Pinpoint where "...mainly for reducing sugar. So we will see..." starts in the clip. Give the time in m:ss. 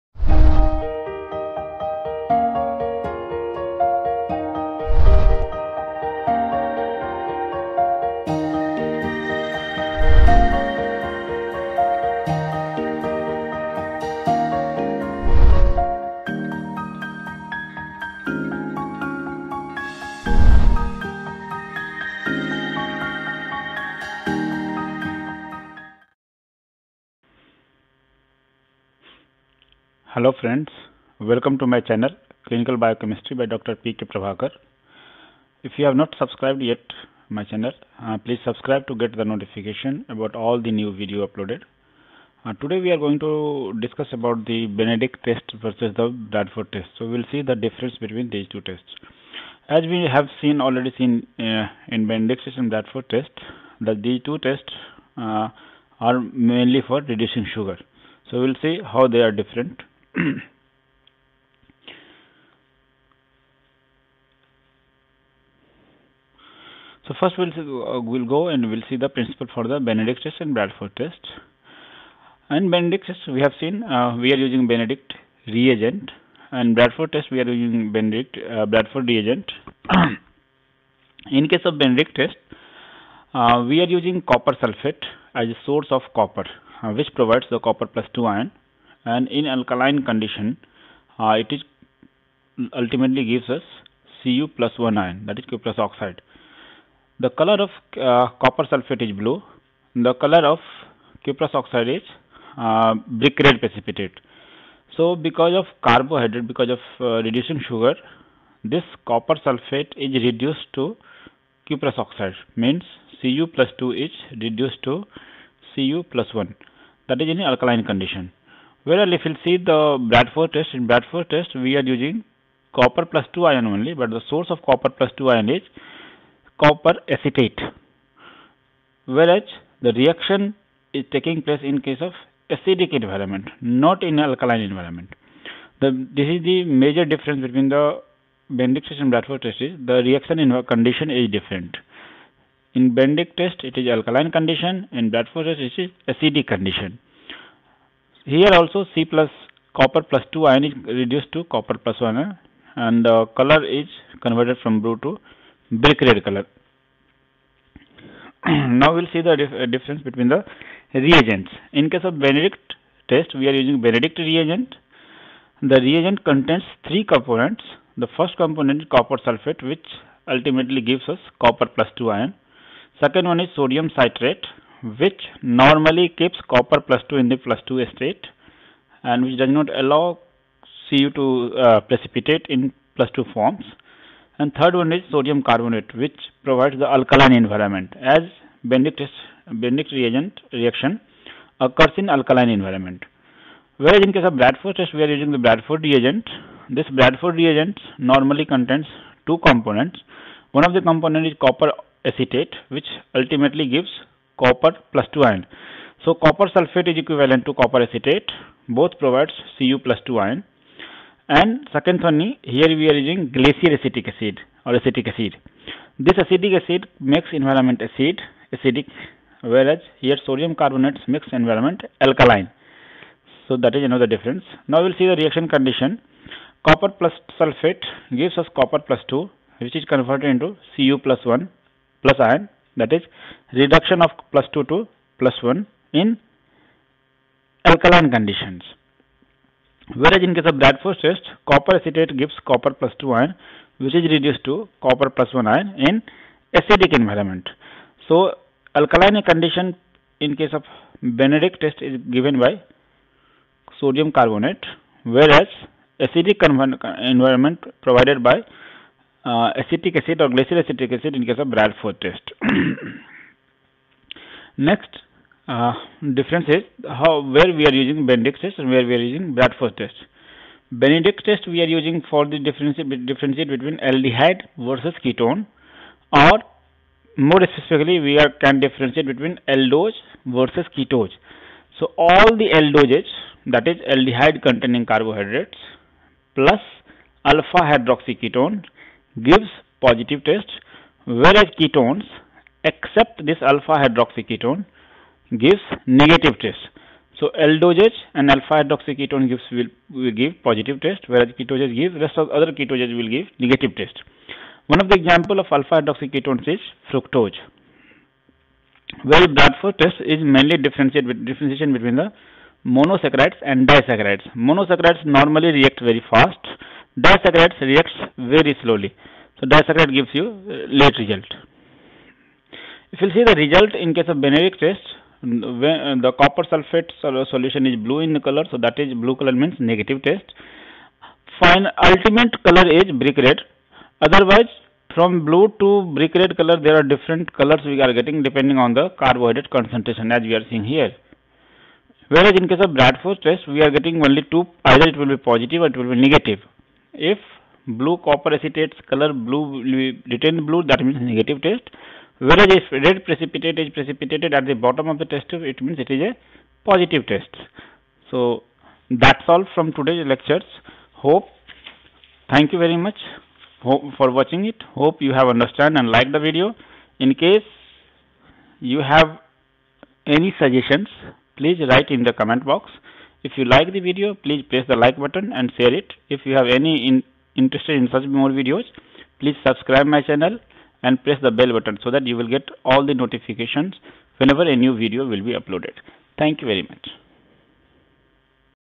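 0:56.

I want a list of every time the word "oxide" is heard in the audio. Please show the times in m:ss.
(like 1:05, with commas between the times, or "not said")
1:35, 1:41, 1:51.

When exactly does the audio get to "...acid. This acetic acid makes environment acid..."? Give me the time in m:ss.
3:35.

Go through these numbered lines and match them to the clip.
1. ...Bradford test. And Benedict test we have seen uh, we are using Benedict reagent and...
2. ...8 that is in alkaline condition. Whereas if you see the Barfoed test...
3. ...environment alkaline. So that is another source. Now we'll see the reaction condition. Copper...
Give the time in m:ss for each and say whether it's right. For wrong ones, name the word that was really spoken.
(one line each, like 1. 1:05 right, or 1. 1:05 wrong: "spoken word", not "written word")
1. 1:10 right
2. 1:56 wrong: "1", not "8"
3. 3:41 wrong: "difference", not "source".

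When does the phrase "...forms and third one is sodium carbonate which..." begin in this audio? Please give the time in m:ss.
3:03.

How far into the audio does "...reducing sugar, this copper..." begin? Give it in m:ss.
1:47.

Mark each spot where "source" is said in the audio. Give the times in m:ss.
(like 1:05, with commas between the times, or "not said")
1:25, 2:04.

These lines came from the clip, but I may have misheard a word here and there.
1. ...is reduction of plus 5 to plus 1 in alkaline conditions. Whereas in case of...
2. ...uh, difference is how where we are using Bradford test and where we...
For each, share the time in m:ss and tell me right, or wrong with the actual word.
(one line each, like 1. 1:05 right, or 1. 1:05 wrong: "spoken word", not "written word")
1. 3:52 wrong: "2", not "5"
2. 4:25 wrong: "Benedict", not "Bradford".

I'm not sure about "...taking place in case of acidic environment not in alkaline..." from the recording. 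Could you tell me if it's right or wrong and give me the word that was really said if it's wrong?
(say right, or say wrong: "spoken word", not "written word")
right.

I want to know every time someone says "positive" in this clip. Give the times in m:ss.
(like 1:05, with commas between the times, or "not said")
4:49, 5:00, 5:45, 5:56.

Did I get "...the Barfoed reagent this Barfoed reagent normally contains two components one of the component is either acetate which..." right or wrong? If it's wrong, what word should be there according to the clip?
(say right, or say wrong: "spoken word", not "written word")
wrong: "copper", not "either".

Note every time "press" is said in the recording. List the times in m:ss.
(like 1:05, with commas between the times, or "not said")
6:14, 6:21.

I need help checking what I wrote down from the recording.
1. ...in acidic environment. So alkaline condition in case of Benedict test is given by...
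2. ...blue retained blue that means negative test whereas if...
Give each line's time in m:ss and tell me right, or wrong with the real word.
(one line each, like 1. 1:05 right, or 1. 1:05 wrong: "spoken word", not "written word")
1. 4:05 right
2. 5:49 right.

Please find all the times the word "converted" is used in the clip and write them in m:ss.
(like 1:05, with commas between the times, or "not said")
2:34, 3:49.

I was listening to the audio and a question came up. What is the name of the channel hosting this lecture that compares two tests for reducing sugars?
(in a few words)
Clinical Biochemistry.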